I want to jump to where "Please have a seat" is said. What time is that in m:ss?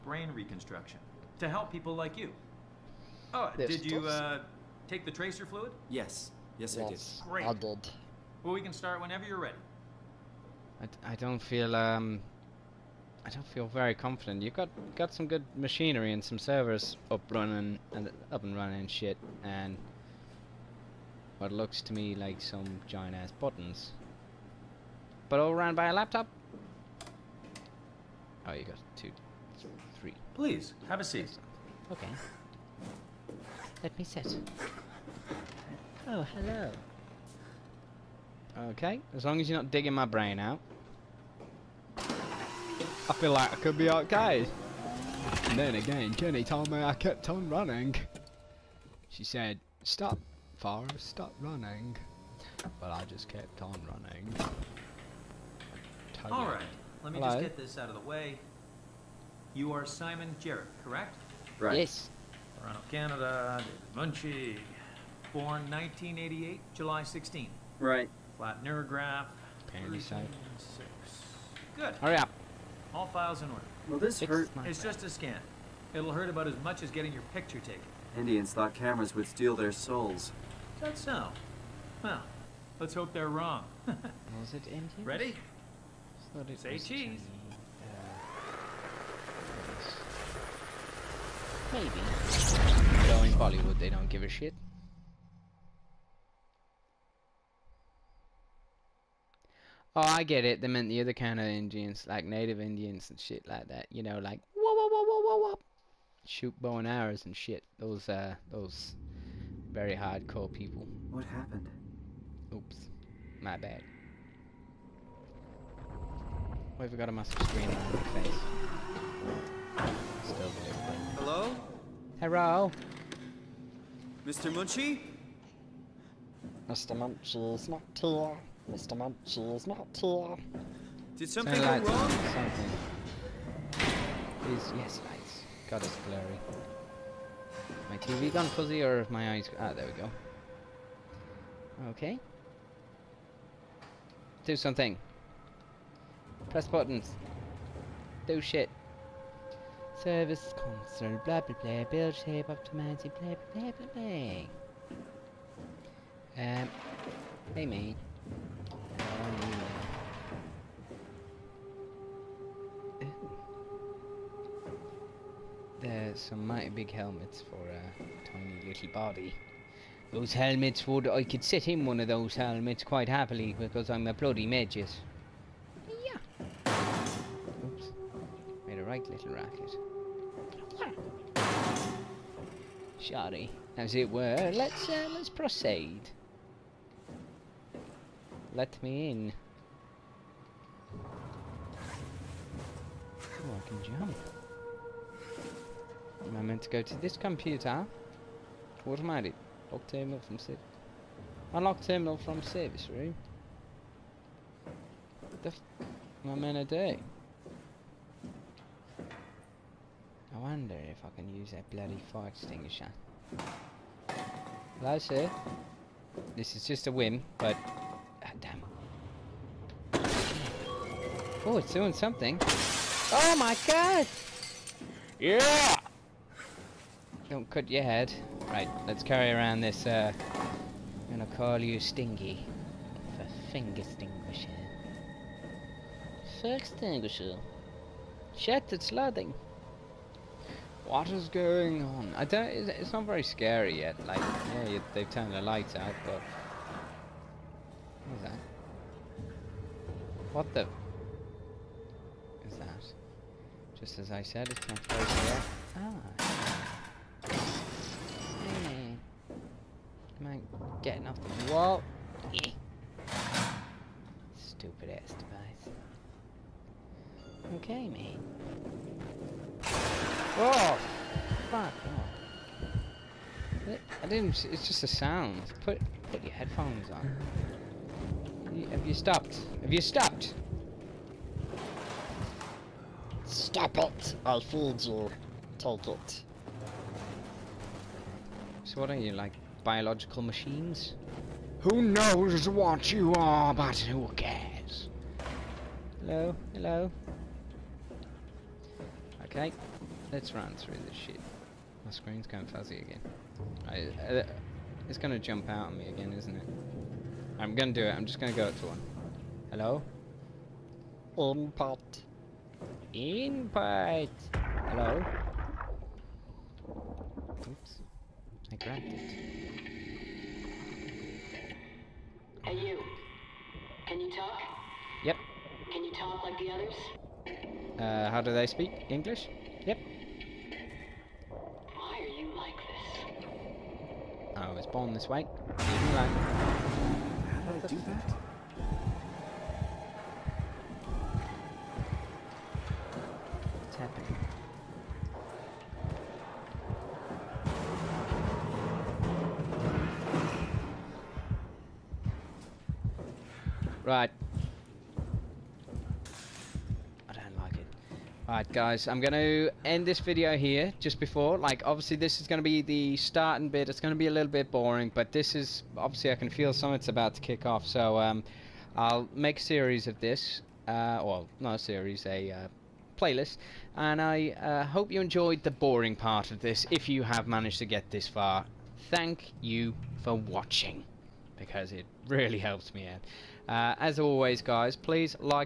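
0:30.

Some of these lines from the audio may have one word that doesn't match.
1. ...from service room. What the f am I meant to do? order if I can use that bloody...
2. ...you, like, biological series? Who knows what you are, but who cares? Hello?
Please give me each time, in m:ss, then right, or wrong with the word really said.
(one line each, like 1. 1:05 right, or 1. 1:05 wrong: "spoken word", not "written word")
1. 3:22 wrong: "wonder", not "order"
2. 4:48 wrong: "machines", not "series".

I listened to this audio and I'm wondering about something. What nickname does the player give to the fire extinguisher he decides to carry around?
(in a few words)
Stingy.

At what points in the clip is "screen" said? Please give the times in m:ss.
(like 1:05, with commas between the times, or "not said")
1:57, 5:01.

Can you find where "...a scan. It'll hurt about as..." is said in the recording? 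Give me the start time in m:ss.
1:15.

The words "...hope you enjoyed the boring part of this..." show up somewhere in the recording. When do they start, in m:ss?
6:14.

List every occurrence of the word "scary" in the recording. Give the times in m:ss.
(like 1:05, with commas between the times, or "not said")
4:03, 4:15.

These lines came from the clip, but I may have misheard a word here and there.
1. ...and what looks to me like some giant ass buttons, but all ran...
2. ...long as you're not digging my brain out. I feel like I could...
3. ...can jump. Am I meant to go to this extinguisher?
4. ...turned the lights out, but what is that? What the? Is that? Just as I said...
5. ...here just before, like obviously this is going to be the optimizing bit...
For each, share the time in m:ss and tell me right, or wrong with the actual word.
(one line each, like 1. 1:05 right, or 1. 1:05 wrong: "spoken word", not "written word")
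1. 0:19 right
2. 0:39 right
3. 3:13 wrong: "computer", not "extinguisher"
4. 4:05 right
5. 6:00 wrong: "starting", not "optimizing".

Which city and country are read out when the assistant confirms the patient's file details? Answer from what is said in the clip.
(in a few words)
Toronto, Canada.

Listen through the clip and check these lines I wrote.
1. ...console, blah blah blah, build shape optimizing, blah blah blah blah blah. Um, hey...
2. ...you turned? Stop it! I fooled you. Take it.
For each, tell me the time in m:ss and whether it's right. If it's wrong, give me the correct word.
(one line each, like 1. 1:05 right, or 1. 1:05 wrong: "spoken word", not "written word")
1. 2:30 right
2. 4:39 wrong: "stopped", not "turned".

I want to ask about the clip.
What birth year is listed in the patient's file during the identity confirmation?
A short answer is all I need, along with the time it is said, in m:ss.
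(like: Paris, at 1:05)
1988, at 1:05.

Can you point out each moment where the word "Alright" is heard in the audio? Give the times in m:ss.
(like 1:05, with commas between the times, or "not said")
0:56, 5:58.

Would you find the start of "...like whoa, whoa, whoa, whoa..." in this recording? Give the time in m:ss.
1:44.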